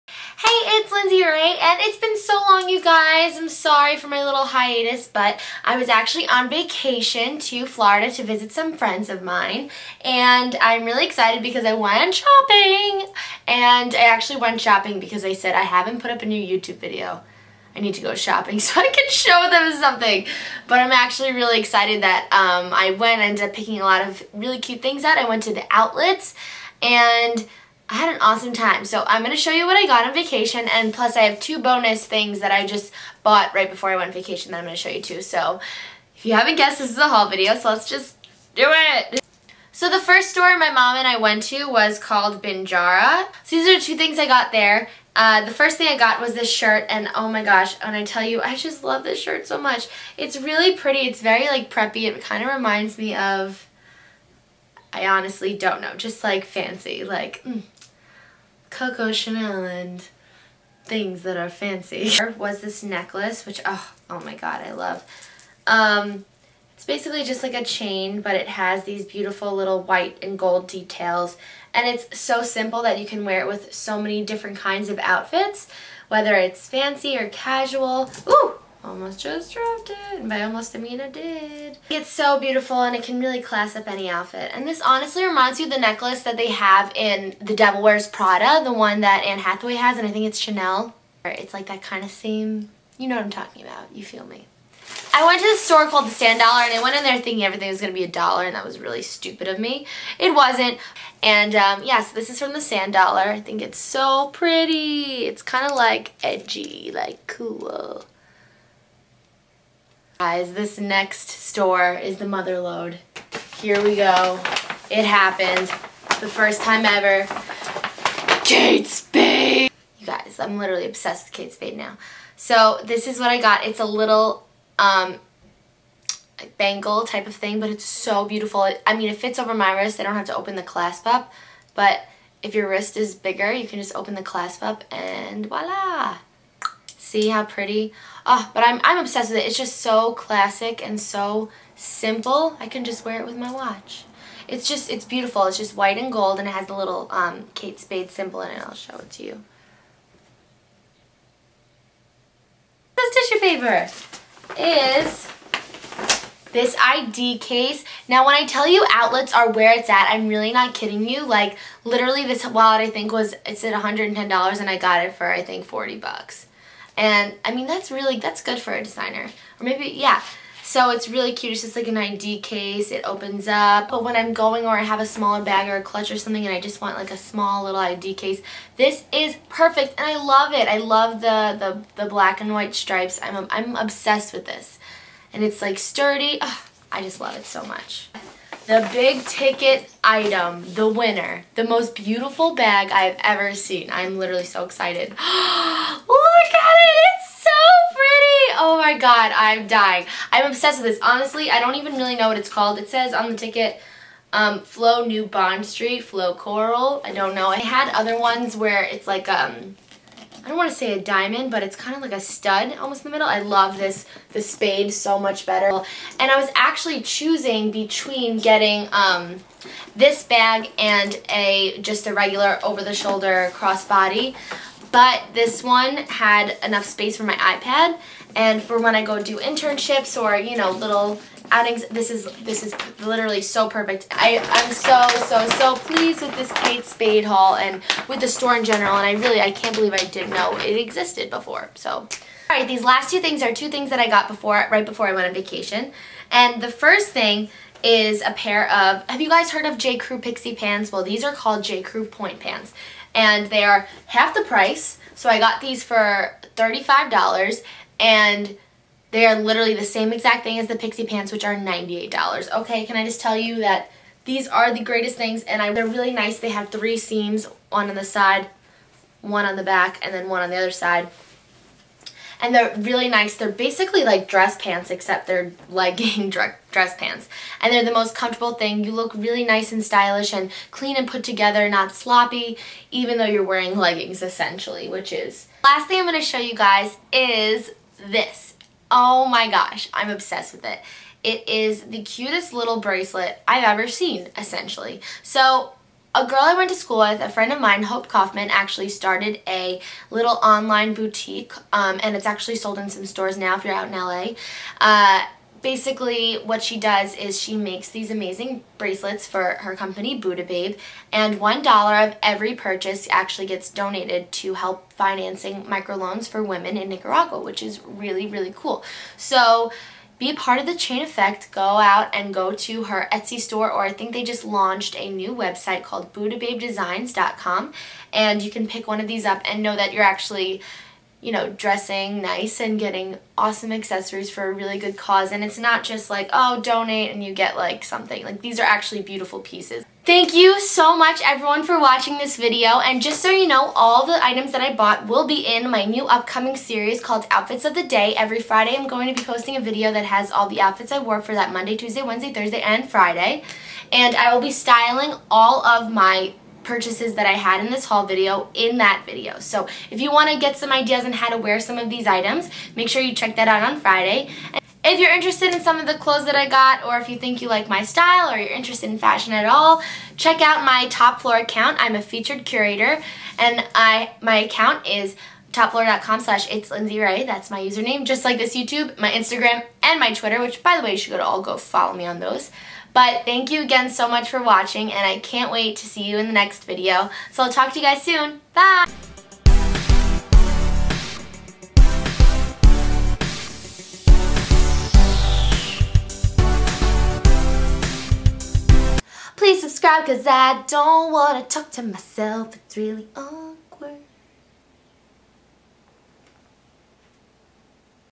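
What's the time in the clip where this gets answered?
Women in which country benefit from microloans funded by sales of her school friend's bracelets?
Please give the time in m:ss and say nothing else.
5:16.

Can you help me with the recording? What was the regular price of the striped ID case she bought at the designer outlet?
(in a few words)
$110.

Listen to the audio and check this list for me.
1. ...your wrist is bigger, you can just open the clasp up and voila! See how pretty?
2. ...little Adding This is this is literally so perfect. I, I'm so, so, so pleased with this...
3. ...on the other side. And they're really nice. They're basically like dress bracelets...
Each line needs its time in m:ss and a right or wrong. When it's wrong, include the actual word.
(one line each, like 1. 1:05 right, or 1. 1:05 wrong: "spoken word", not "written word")
1. 2:12 right
2. 3:50 right
3. 4:30 wrong: "pants", not "bracelets".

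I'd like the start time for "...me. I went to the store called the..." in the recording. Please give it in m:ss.
1:34.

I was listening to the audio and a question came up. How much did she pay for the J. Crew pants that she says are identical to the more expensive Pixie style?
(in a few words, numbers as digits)
$35.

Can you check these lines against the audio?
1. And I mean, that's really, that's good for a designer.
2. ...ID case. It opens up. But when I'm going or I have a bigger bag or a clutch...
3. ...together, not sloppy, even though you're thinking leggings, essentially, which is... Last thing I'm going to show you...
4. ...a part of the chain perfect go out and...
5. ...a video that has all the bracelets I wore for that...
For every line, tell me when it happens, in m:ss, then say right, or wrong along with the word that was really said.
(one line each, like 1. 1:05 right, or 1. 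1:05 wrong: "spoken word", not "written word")
1. 2:46 right
2. 2:51 wrong: "smaller", not "bigger"
3. 4:41 wrong: "wearing", not "thinking"
4. 5:20 wrong: "effect", not "perfect"
5. 5:49 wrong: "outfits", not "bracelets".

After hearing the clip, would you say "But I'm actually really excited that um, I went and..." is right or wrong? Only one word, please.
right.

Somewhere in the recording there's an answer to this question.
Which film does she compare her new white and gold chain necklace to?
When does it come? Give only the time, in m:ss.
1:27.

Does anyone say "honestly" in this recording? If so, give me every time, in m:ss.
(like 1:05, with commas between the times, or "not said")
0:55, 1:24, 3:21.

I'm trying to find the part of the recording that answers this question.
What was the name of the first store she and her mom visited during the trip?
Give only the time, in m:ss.
0:42.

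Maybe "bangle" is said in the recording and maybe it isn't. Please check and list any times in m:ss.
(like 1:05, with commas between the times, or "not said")
2:06.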